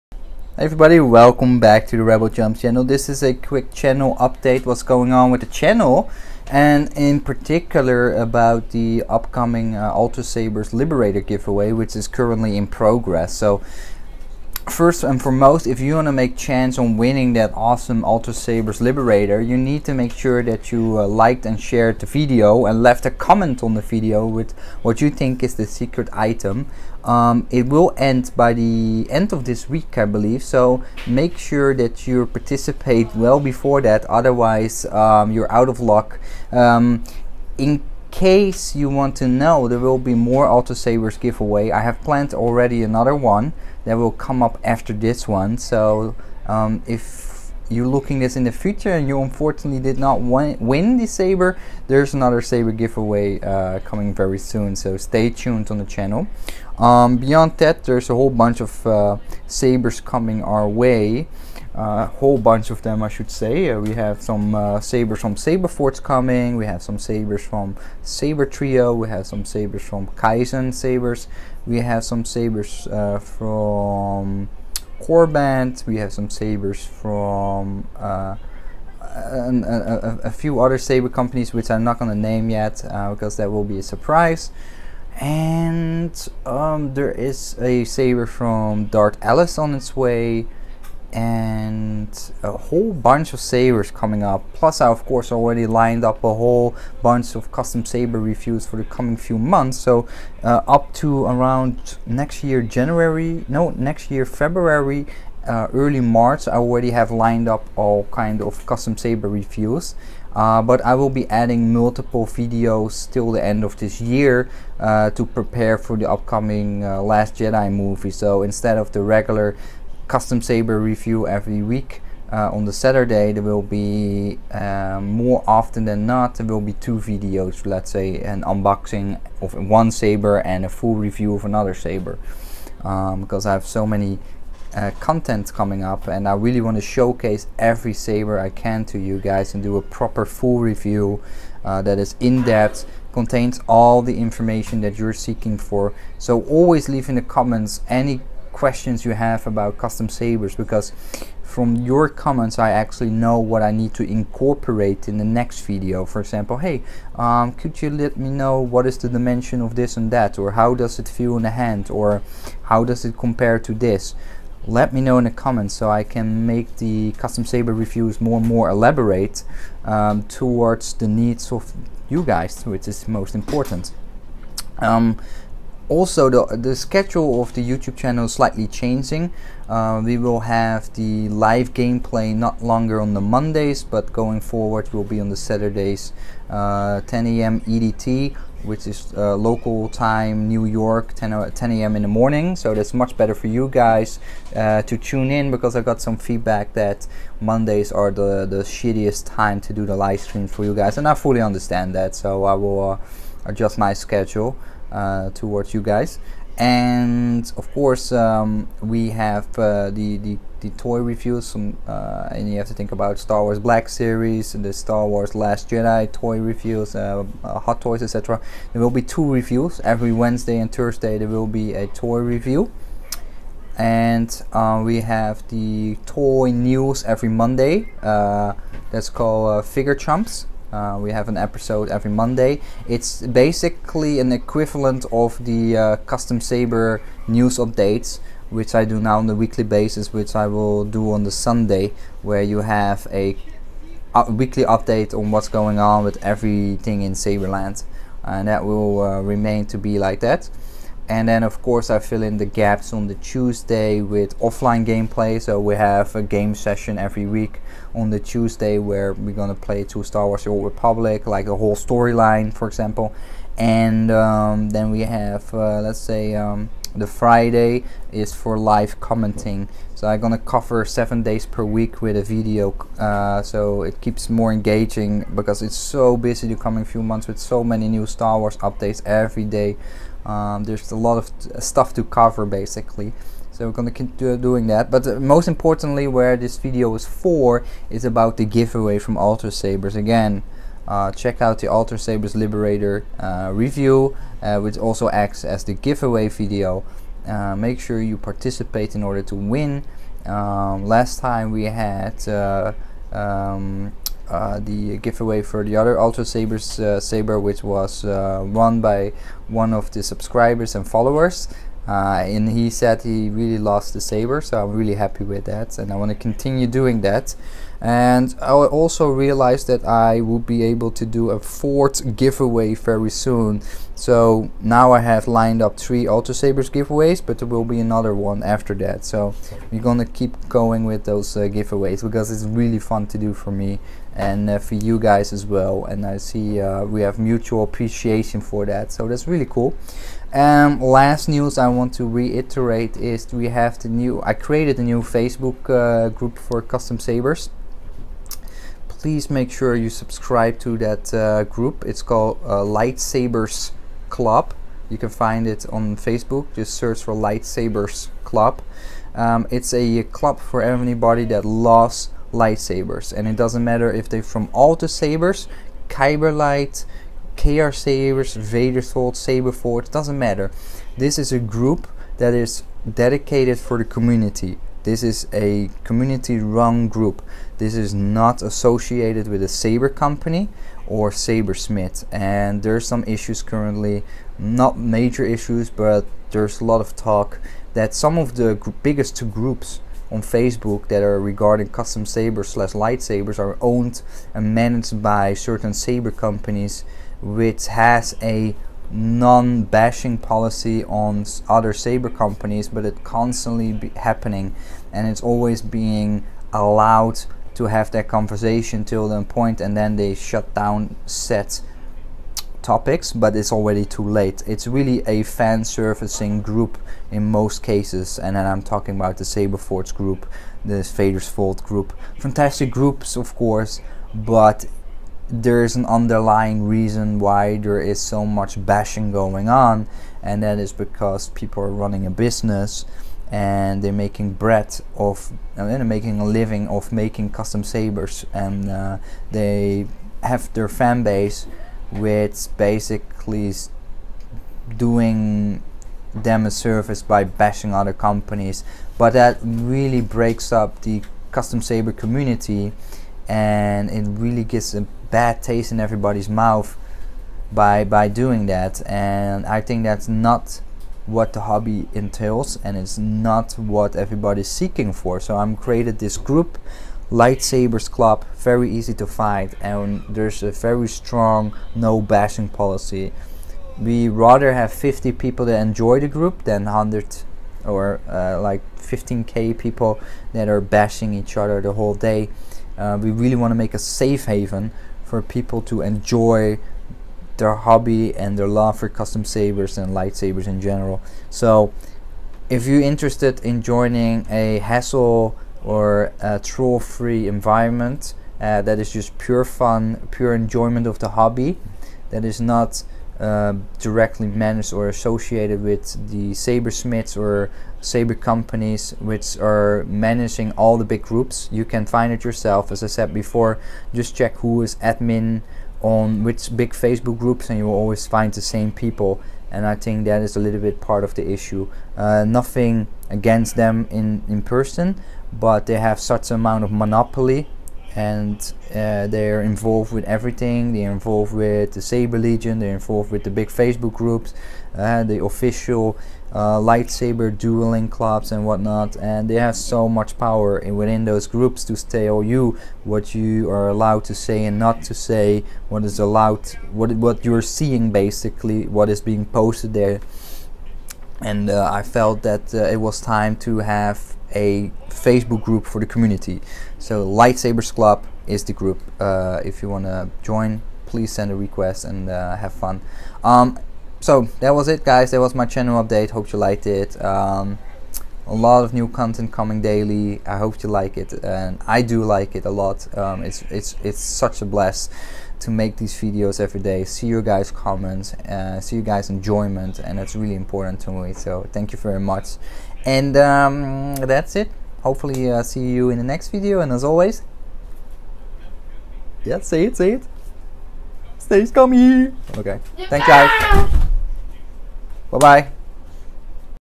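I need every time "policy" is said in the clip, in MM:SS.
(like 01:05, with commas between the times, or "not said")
06:40, 07:52.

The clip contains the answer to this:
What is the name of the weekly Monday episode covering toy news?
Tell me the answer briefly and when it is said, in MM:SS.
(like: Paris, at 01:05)
Figure Chumps, at 03:49.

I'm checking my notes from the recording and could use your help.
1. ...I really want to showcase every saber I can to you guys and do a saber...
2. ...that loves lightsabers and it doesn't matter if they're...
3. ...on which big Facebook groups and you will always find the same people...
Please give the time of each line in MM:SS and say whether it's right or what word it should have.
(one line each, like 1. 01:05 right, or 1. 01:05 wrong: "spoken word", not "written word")
1. 02:16 wrong: "proper", not "saber"
2. 06:01 right
3. 08:35 right.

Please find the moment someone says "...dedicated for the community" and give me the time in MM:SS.
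06:12.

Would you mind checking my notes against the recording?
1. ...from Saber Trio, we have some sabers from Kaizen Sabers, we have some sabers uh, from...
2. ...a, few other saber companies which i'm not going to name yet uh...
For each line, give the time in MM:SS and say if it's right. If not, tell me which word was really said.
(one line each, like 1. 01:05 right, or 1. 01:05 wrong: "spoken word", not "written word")
1. 01:07 right
2. 01:20 right.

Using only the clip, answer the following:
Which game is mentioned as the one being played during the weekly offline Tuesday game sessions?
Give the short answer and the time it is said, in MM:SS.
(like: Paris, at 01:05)
Star Wars The Old Republic, at 04:20.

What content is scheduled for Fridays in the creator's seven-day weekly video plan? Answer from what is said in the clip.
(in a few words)
Live commenting.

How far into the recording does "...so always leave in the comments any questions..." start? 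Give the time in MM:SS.
02:26.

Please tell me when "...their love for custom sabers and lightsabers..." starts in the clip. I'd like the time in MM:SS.
08:08.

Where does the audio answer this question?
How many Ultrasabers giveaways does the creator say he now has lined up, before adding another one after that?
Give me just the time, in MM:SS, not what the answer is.
05:25.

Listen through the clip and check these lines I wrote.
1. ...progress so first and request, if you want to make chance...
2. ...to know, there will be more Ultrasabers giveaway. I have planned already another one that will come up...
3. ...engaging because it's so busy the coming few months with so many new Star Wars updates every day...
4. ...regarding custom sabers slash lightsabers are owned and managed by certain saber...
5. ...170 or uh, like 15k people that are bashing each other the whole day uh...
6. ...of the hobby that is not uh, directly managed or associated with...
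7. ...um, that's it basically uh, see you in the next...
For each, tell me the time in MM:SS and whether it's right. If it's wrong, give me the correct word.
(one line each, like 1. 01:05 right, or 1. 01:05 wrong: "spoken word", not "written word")
1. 00:12 wrong: "foremost", not "request"
2. 00:39 right
3. 04:34 right
4. 06:31 right
5. 07:56 wrong: "100", not "170"
6. 08:20 right
7. 09:43 wrong: "hopefully", not "basically".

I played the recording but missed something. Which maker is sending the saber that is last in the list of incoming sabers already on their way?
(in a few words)
Dart Alice.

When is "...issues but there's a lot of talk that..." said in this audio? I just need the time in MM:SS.
06:25.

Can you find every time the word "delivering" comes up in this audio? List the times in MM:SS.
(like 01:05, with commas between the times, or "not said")
not said.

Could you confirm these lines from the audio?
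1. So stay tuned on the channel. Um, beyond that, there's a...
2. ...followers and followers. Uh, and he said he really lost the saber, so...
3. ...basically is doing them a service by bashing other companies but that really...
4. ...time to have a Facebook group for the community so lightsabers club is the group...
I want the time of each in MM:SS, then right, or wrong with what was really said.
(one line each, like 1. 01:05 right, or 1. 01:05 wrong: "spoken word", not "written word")
1. 00:54 right
2. 05:10 wrong: "subscribers", not "followers"
3. 07:22 right
4. 09:13 right.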